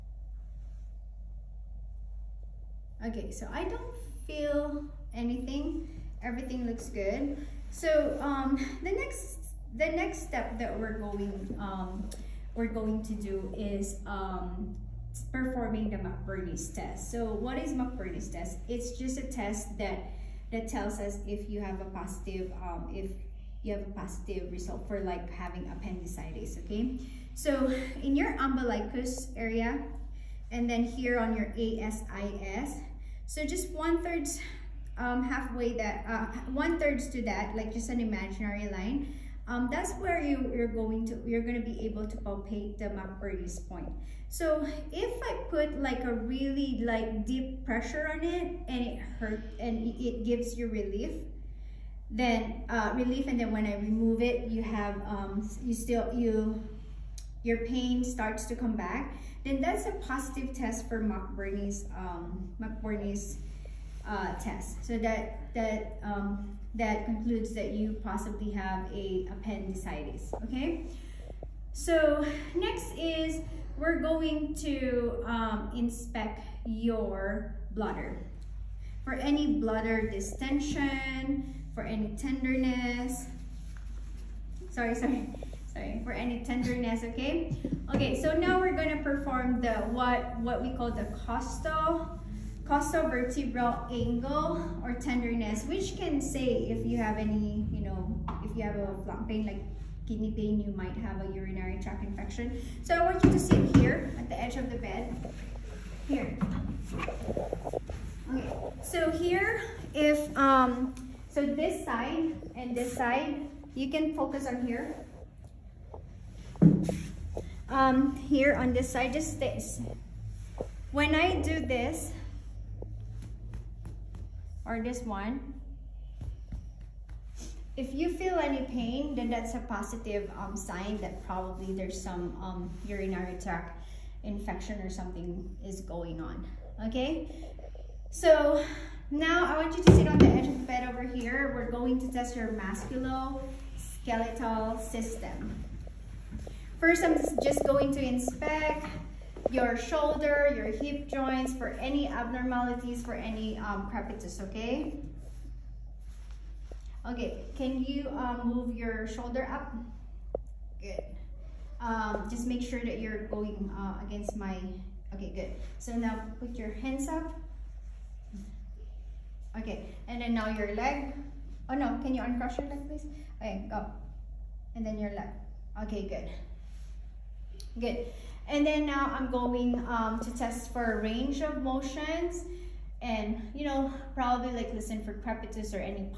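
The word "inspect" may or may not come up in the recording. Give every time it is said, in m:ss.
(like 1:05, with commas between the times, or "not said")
1:15, 2:28.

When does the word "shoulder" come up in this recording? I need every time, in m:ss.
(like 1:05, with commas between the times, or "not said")
2:29, 2:39.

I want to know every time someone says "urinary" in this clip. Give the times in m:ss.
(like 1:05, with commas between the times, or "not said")
1:41, 2:12.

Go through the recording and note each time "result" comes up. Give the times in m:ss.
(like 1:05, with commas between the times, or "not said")
0:24.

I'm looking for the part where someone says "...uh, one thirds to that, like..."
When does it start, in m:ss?
0:36.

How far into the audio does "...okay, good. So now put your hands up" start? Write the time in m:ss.
2:45.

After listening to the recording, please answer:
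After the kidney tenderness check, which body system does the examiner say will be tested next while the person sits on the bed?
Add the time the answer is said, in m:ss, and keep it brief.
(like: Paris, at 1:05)
musculoskeletal system, at 2:22.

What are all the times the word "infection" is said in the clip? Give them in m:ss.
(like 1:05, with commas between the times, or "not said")
1:42, 2:14.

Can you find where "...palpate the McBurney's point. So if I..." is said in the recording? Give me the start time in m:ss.
0:42.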